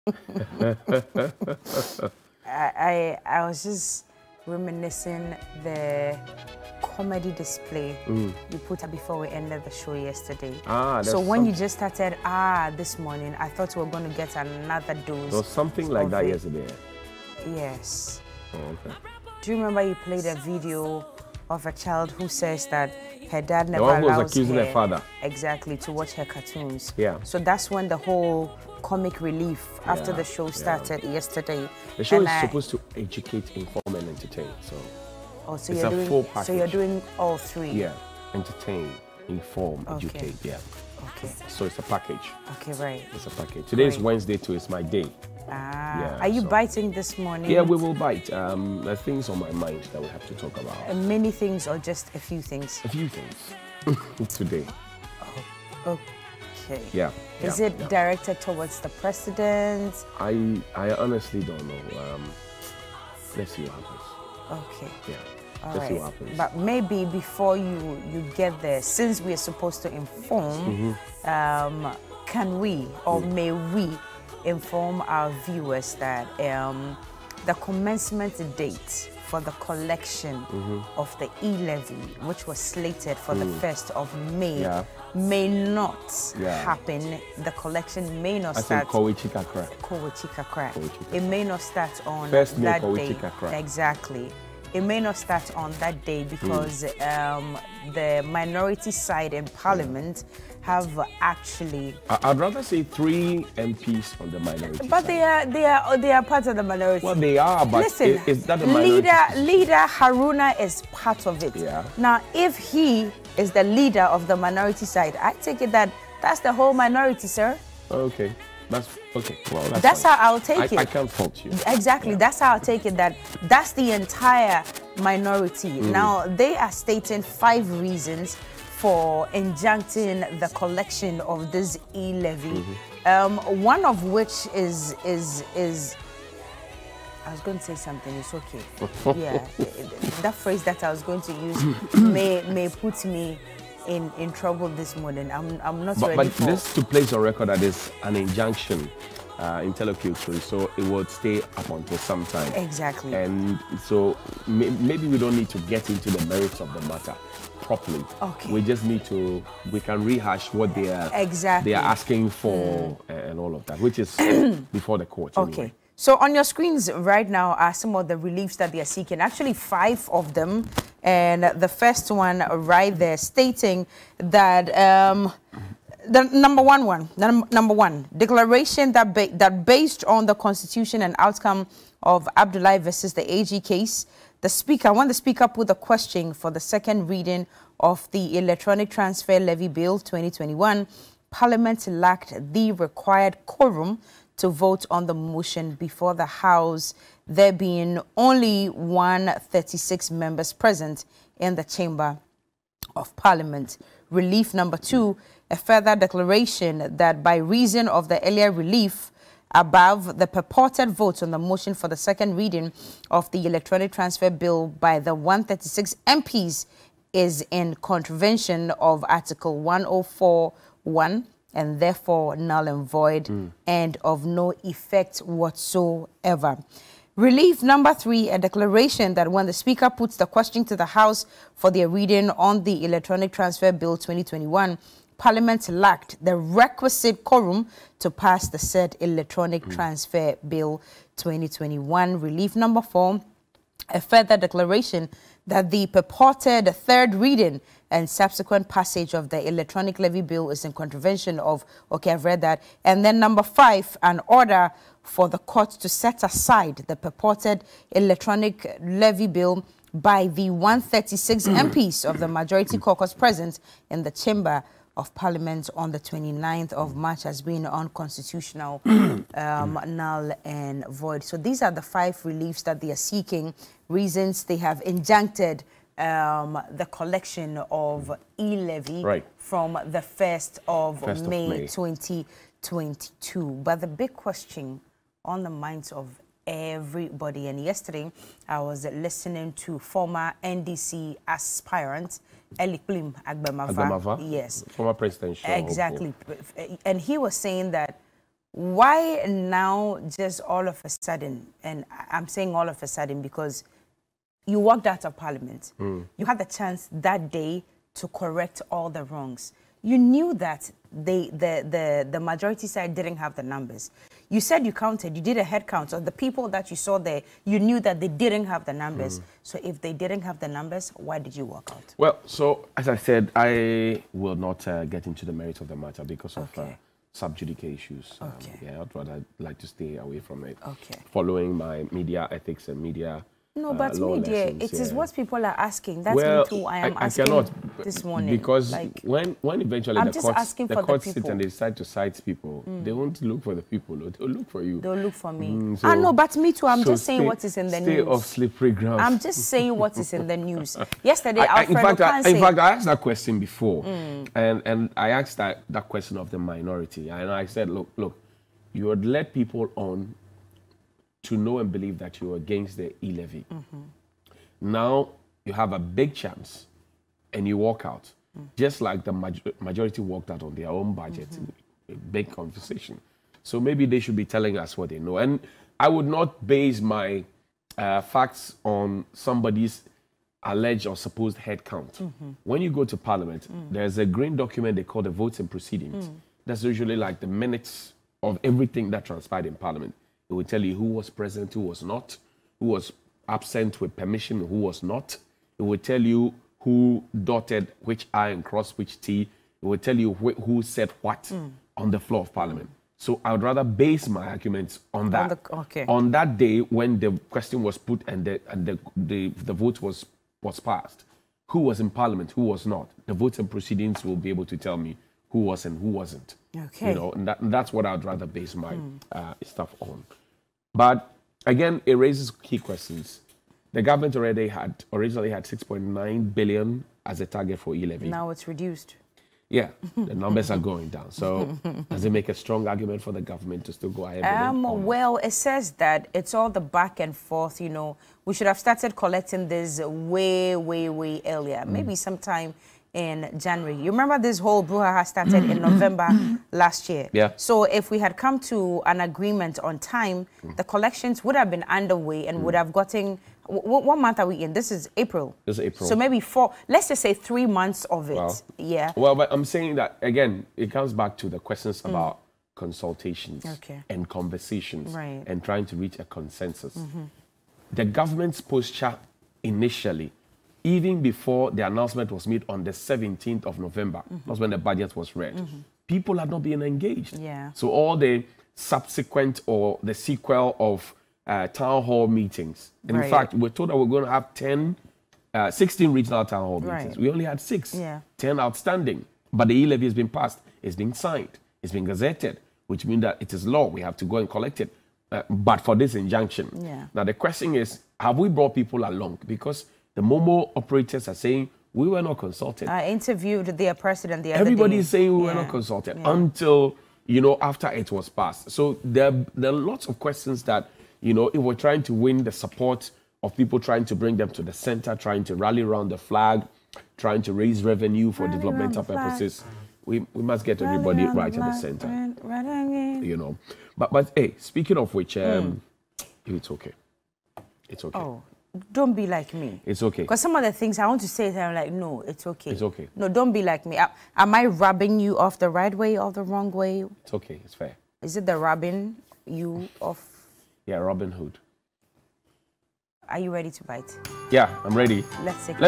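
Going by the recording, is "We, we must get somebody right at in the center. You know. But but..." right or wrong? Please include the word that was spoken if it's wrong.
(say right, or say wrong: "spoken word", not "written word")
wrong: "everybody", not "somebody".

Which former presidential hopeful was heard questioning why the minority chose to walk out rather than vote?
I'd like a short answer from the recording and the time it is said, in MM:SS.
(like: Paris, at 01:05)
Elikplim Agbemava, at 04:52.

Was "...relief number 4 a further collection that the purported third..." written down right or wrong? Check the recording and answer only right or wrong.
wrong.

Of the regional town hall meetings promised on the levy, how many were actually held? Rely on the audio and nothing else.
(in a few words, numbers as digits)
6.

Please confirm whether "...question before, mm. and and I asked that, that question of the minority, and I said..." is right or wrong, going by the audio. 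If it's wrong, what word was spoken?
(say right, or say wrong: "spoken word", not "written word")
right.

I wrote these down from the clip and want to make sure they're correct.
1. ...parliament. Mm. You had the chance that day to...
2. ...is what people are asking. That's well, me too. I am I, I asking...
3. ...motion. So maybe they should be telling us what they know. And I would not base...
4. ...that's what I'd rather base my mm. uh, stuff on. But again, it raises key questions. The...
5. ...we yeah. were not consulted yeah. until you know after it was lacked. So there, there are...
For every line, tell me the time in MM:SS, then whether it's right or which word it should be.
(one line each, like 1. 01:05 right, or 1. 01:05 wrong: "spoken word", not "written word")
1. 05:05 right
2. 05:34 right
3. 06:12 wrong: "conversation", not "motion"
4. 06:57 right
5. 08:25 wrong: "passed", not "lacked".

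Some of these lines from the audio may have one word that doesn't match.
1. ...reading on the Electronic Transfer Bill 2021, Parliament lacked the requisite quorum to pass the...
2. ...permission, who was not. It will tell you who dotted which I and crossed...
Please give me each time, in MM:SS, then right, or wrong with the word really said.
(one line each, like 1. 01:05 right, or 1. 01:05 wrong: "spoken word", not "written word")
1. 03:51 right
2. 06:33 right.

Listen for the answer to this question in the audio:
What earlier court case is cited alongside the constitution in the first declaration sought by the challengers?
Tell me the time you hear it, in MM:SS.
03:02.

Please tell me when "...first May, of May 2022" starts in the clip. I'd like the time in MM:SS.
04:40.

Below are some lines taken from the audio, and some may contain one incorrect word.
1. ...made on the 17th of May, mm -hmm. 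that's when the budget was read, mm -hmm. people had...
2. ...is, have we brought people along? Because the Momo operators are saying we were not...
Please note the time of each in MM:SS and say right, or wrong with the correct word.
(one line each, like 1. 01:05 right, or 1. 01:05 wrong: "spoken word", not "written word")
1. 07:52 wrong: "November", not "May"
2. 08:17 right.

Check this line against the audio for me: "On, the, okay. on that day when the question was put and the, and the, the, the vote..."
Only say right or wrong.
right.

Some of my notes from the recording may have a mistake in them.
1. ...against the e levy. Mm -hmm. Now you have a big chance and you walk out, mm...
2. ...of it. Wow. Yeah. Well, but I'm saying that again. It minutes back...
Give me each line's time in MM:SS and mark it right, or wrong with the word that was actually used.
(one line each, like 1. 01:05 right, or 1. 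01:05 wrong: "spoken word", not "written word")
1. 06:02 right
2. 07:37 wrong: "comes", not "minutes".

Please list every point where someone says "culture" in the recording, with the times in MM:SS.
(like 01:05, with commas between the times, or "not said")
not said.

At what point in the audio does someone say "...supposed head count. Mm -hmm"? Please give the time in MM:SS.
06:20.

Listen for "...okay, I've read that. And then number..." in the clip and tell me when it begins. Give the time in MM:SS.
04:11.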